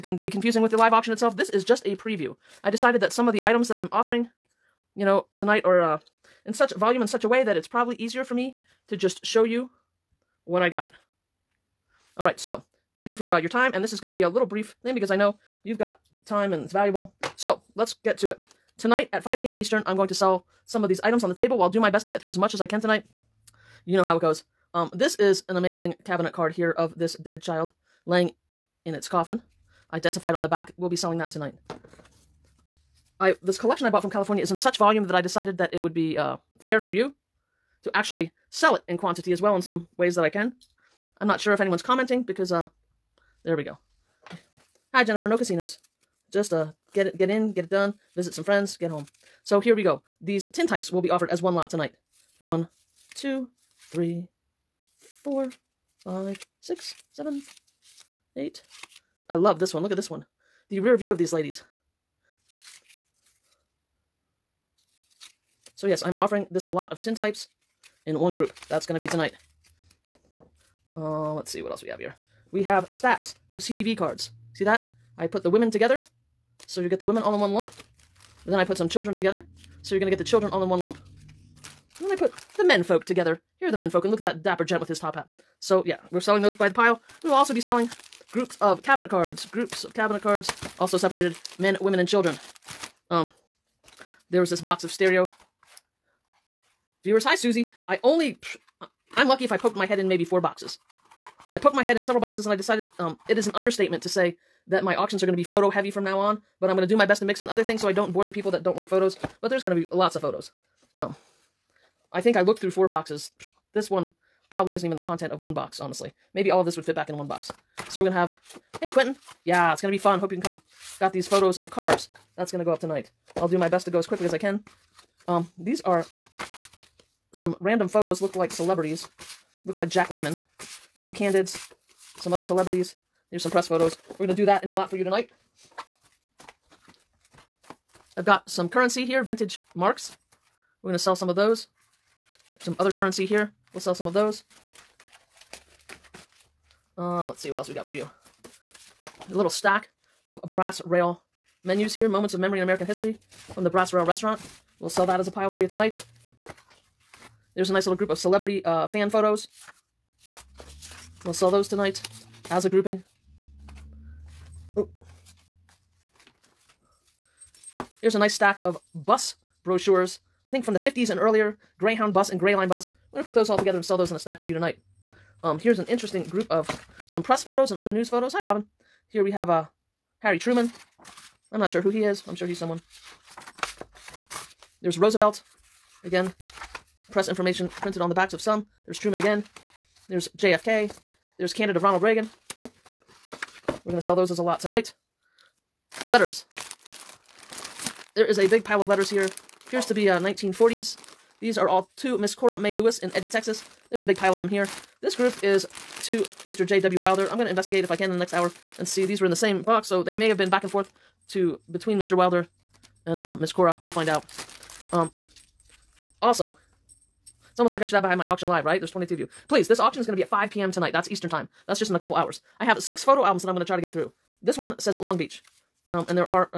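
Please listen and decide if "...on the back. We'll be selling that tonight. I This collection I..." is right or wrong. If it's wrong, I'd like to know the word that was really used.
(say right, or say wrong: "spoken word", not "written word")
right.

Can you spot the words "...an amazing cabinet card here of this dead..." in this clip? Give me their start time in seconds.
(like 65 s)
25 s.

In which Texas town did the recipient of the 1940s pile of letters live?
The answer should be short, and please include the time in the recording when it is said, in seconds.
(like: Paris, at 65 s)
Eddy, at 203 s.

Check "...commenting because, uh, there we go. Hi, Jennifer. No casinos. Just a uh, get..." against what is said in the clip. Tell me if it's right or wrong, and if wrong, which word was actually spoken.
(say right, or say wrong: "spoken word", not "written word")
right.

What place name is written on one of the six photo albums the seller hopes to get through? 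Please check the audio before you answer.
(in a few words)
Long Beach.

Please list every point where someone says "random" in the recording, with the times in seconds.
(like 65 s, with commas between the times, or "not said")
127 s.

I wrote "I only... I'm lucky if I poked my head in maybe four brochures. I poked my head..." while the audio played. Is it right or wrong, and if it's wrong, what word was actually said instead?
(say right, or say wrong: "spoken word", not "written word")
wrong: "boxes", not "brochures".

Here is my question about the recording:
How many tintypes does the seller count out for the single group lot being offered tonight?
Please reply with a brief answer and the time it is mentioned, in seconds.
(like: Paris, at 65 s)
8, at 58 s.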